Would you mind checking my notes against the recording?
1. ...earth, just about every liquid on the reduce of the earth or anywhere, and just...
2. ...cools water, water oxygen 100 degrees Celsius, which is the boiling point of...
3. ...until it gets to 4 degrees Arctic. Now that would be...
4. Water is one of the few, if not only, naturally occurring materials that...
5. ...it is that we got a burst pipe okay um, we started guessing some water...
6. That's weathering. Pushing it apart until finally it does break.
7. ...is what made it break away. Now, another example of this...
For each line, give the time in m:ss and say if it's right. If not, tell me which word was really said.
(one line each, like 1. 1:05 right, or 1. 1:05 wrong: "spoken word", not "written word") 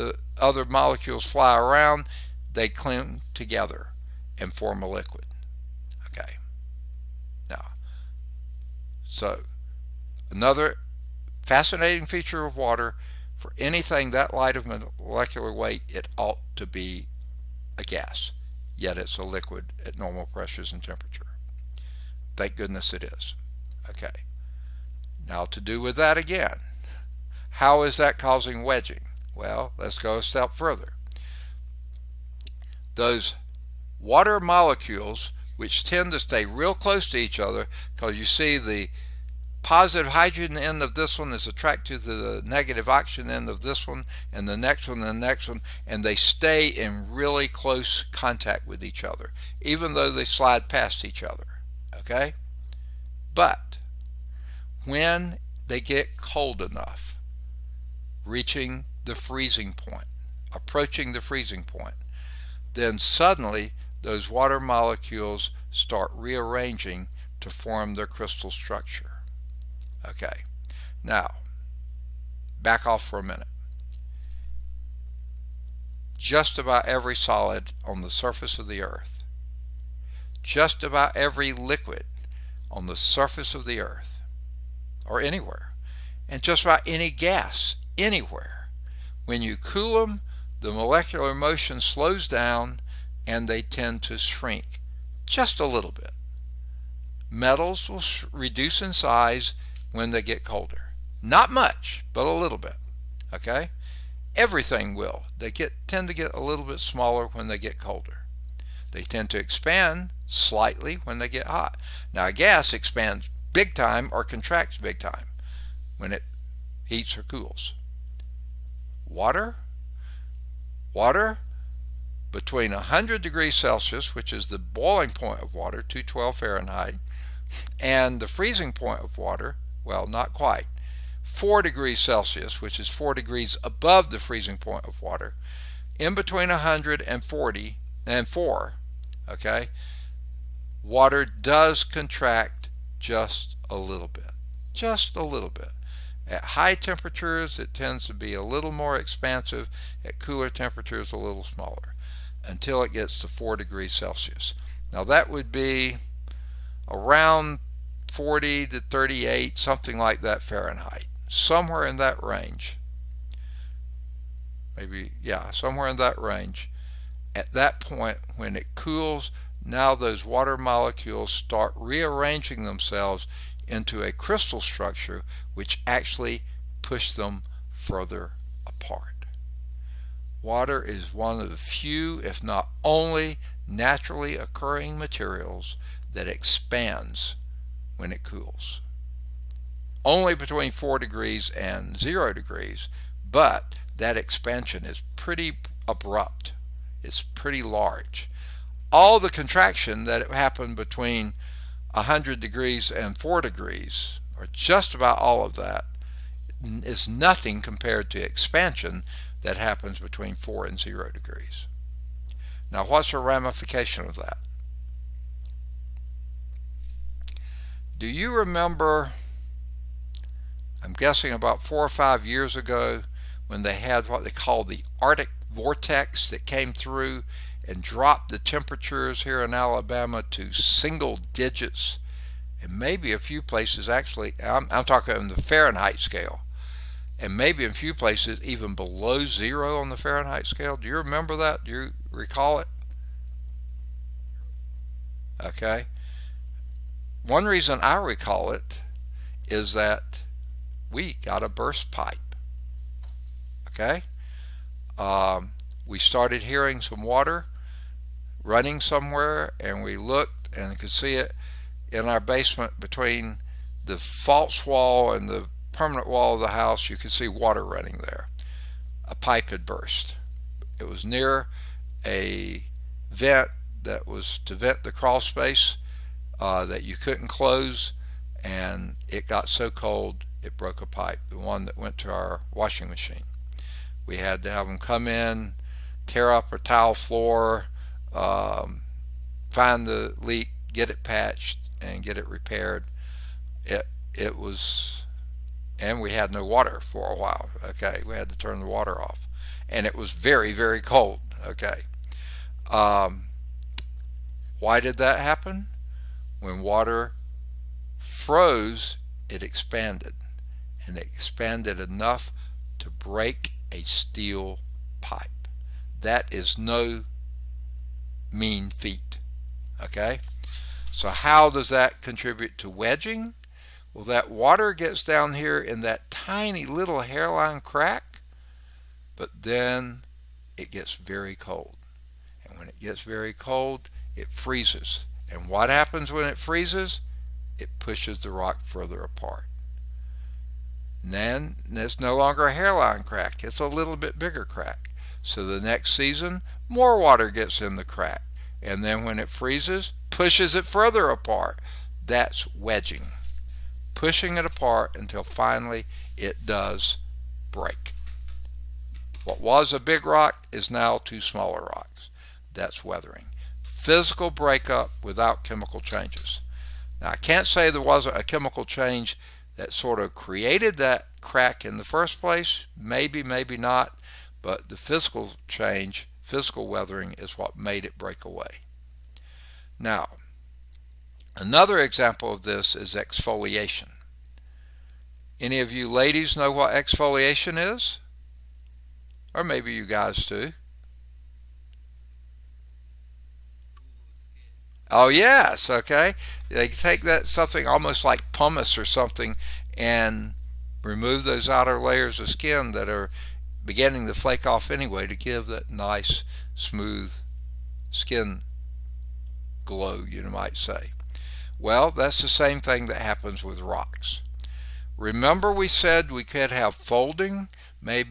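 1. 1:18 wrong: "surface", not "reduce"
2. 1:57 wrong: "between", not "oxygen"
3. 2:32 wrong: "Celsius", not "Arctic"
4. 3:00 right
5. 4:08 wrong: "hearing", not "guessing"
6. 5:52 wrong: "wedging", not "weathering"
7. 6:17 right.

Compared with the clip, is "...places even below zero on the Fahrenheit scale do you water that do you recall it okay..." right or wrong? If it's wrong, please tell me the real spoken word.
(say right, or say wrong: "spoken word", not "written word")
wrong: "remember", not "water".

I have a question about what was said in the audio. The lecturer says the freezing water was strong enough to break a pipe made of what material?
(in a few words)
steel.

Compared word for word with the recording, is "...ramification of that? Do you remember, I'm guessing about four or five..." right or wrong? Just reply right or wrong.
right.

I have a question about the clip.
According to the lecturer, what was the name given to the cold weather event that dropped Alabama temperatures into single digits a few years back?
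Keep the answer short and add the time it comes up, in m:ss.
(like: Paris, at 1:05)
Arctic vortex, at 3:44.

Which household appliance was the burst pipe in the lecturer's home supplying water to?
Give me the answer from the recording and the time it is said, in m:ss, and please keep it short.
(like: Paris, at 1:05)
washing machine, at 4:42.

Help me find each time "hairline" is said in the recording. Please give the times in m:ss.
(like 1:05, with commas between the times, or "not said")
5:27, 5:42.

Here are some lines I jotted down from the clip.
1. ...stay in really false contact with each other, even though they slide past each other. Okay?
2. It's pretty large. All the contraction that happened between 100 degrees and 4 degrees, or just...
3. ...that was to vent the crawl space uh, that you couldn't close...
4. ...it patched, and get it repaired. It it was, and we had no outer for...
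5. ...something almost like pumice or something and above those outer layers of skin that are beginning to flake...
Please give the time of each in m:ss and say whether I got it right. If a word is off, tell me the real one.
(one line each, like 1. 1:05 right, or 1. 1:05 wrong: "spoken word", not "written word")
1. 0:46 wrong: "close", not "false"
2. 3:17 right
3. 4:33 right
4. 4:50 wrong: "water", not "outer"
5. 6:37 wrong: "remove", not "above".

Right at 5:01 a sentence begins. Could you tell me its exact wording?
Okay, um, why did that happen?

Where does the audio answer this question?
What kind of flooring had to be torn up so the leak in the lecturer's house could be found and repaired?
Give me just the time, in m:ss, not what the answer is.
4:46.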